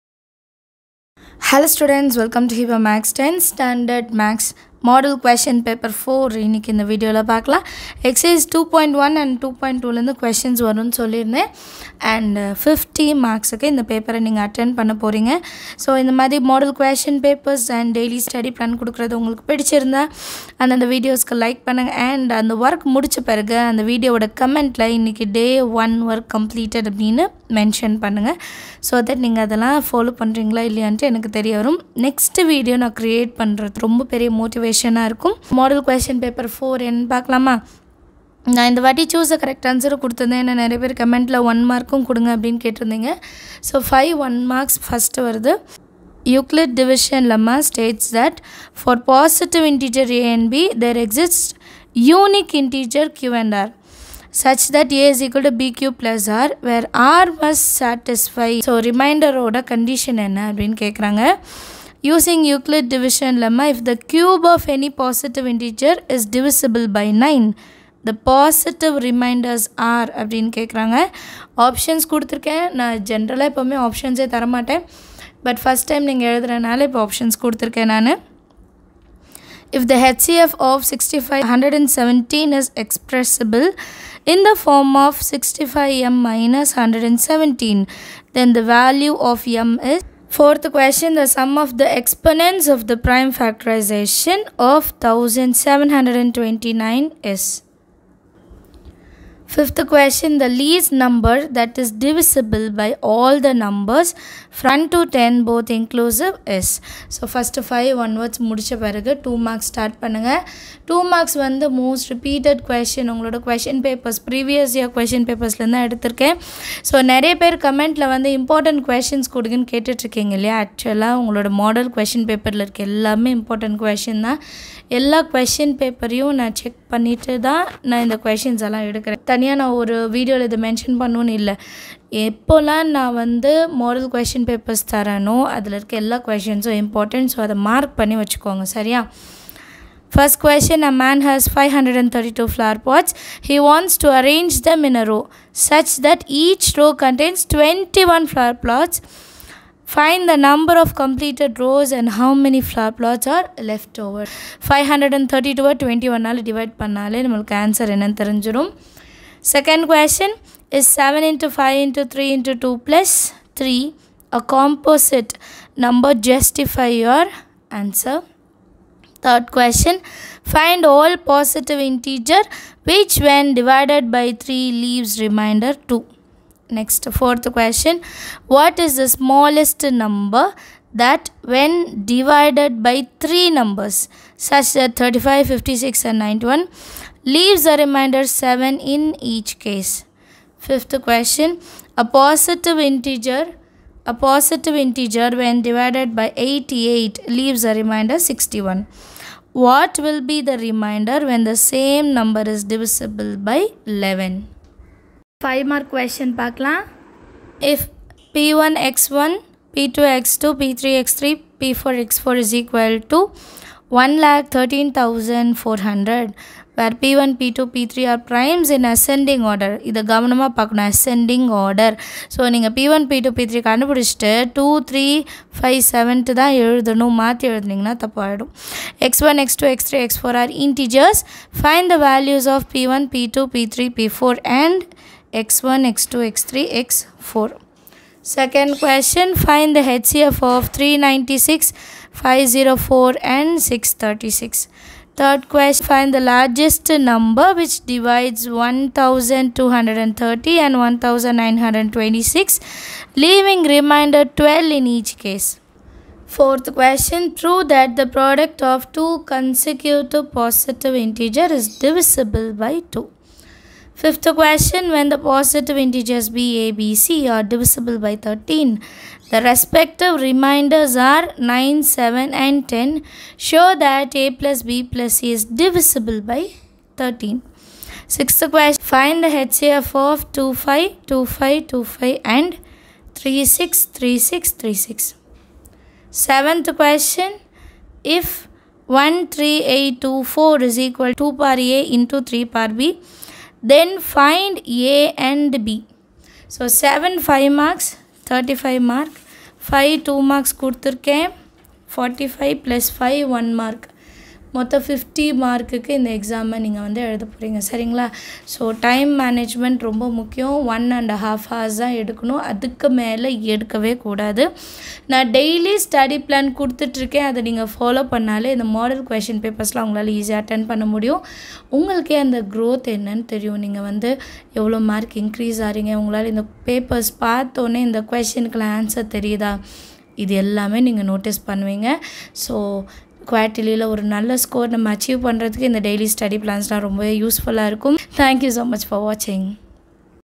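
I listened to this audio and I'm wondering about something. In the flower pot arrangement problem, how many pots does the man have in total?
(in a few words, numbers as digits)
532.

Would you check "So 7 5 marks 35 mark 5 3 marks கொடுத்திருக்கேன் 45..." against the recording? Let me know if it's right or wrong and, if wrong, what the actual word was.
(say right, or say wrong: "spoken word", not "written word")
wrong: "2", not "3".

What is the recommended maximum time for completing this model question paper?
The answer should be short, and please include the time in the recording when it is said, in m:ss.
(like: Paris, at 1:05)
1.5 hours, at 5:10.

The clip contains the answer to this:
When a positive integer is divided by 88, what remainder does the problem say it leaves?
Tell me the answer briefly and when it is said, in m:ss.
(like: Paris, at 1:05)
61, at 3:17.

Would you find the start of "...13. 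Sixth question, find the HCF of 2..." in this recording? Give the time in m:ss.
4:36.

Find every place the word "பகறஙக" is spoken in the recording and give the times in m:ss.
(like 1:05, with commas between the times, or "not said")
0:15, 5:07.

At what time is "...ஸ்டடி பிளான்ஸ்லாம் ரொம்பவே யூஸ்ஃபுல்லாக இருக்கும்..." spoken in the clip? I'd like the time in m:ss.
5:36.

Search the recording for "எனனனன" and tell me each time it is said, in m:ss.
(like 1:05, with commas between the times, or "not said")
2:37, 5:22.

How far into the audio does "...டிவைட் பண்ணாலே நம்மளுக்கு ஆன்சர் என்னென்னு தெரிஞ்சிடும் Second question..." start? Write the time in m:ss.
2:36.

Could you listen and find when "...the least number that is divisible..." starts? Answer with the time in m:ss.
1:40.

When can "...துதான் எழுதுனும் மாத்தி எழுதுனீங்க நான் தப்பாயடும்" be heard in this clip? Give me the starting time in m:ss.
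3:46.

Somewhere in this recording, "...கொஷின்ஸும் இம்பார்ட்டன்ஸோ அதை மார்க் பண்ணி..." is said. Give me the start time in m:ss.
2:16.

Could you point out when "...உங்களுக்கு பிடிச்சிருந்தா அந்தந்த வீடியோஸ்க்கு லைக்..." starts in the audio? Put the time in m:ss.
0:19.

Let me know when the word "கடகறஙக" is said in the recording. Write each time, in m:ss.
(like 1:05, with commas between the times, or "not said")
1:00, 1:10.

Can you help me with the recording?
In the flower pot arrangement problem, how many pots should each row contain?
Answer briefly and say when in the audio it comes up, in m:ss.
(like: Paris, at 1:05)
21, at 2:27.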